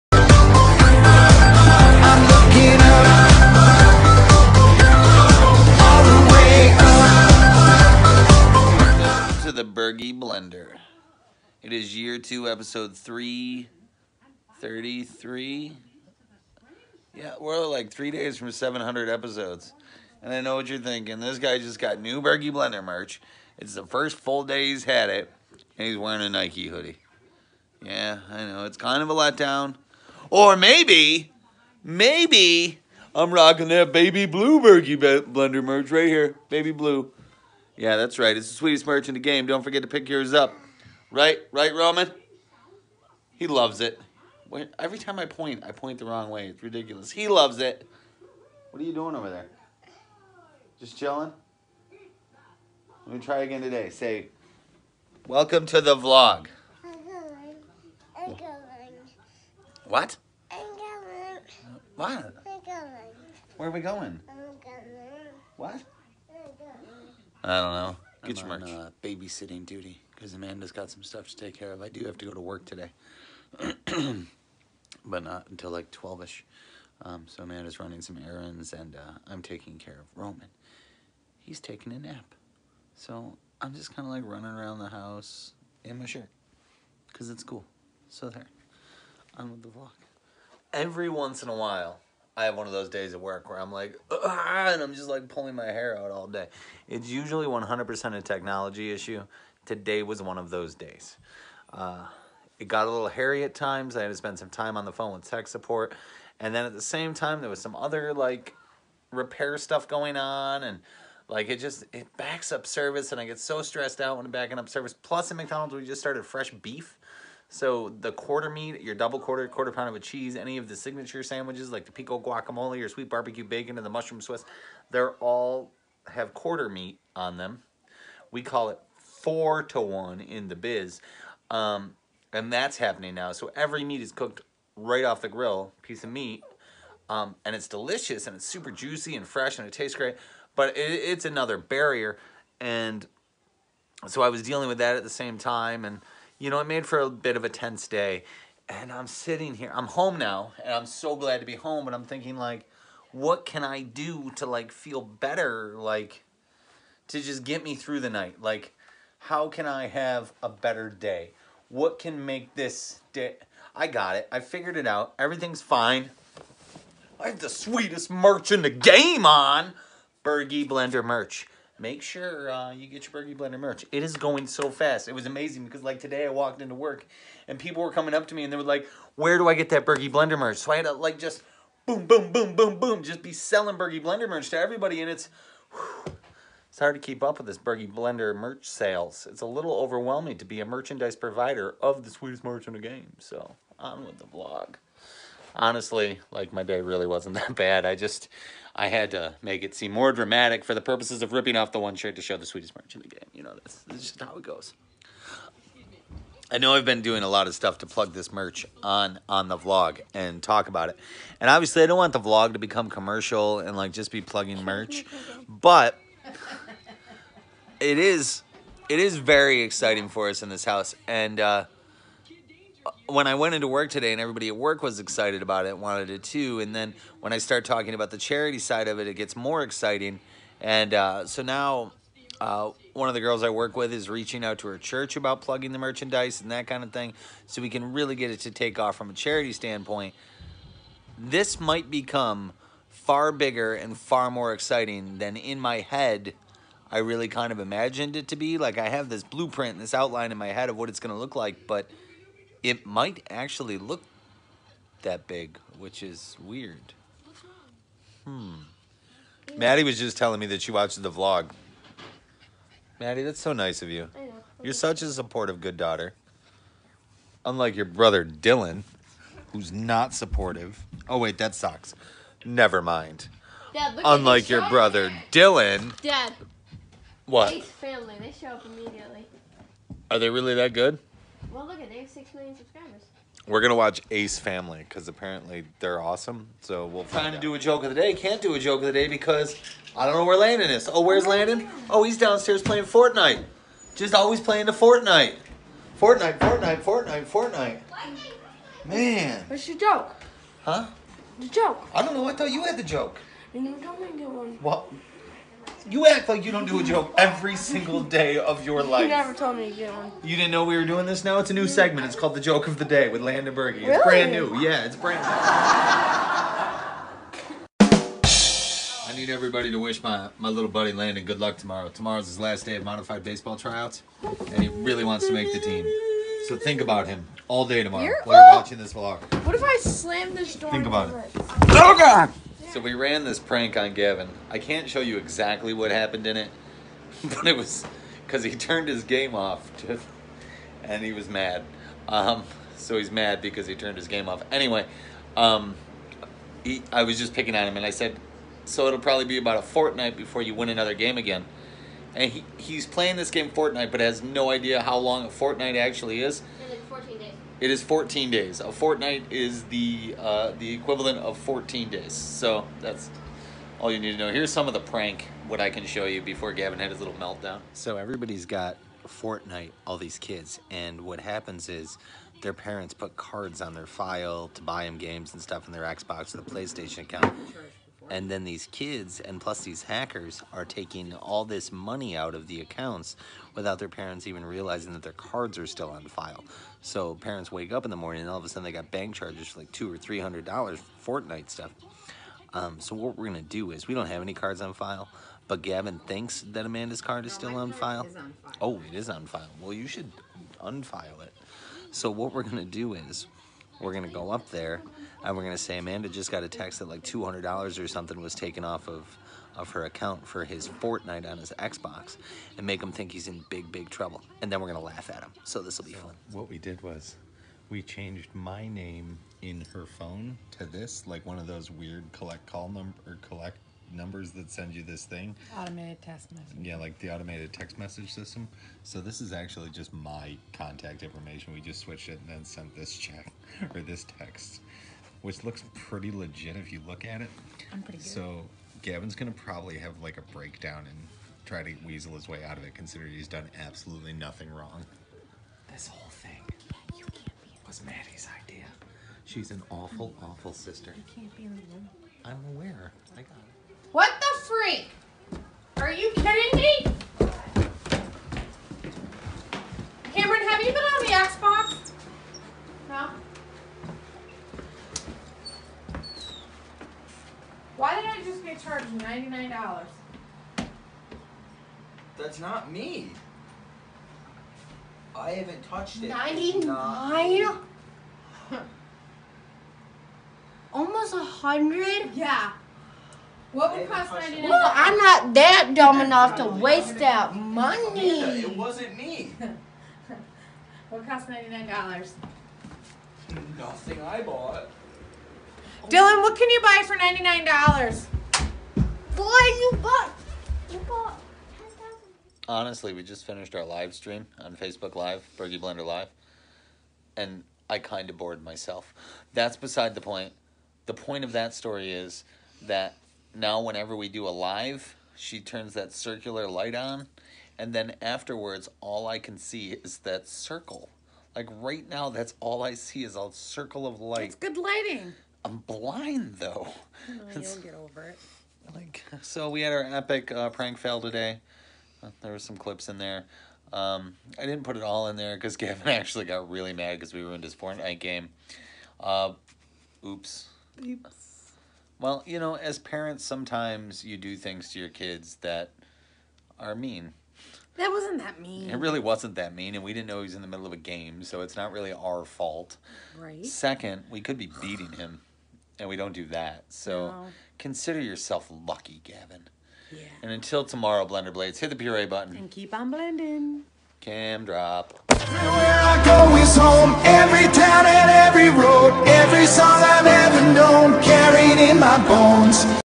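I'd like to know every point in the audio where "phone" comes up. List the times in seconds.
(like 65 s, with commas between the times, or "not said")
104 s, 419 s.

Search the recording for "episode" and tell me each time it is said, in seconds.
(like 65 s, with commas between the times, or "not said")
12 s, 19 s.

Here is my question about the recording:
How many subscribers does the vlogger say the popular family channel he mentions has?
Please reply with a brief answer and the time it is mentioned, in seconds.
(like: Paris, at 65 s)
6 million, at 282 s.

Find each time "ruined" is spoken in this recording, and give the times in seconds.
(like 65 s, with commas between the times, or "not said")
537 s.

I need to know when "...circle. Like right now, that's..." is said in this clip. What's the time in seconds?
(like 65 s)
520 s.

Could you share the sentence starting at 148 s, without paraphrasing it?
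And I'm sitting here, I'm home now, and I'm so glad to be home.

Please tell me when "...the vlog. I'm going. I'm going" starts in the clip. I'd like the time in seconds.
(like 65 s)
55 s.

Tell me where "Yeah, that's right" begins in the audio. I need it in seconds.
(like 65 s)
37 s.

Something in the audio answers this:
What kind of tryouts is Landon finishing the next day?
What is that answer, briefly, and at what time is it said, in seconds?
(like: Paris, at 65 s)
Modified baseball, at 322 s.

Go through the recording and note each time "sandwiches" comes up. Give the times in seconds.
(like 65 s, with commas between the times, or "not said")
121 s.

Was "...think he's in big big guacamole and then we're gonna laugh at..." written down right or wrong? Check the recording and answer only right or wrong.
wrong.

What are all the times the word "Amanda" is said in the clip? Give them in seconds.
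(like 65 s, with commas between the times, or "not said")
70 s, 77 s, 396 s, 405 s.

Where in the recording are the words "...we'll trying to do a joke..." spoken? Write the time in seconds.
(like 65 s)
286 s.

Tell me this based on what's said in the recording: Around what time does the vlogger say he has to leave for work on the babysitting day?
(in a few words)
12.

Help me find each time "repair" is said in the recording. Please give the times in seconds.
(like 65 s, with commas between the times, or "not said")
109 s.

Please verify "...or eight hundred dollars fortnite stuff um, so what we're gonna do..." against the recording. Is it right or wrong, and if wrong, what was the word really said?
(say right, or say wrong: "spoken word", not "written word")
wrong: "three", not "eight".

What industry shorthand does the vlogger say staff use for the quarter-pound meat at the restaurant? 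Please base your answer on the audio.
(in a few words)
Four to one.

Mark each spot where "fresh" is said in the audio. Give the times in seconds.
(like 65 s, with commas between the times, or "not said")
116 s, 139 s.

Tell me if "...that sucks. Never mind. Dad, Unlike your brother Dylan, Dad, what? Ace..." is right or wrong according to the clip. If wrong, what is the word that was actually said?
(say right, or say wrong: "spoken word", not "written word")
right.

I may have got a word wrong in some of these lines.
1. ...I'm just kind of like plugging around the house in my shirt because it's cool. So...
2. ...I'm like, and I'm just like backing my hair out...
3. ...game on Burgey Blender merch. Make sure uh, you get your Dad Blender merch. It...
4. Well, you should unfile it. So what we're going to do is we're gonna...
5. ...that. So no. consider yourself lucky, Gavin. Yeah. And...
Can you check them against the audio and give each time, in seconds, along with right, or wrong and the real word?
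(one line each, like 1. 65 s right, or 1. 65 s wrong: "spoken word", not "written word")
1. 83 s wrong: "running", not "plugging"
2. 93 s wrong: "pulling", not "backing"
3. 168 s wrong: "Burgey", not "Dad"
4. 399 s right
5. 556 s right.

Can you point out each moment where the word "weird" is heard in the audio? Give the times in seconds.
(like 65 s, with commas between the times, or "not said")
256 s, 421 s.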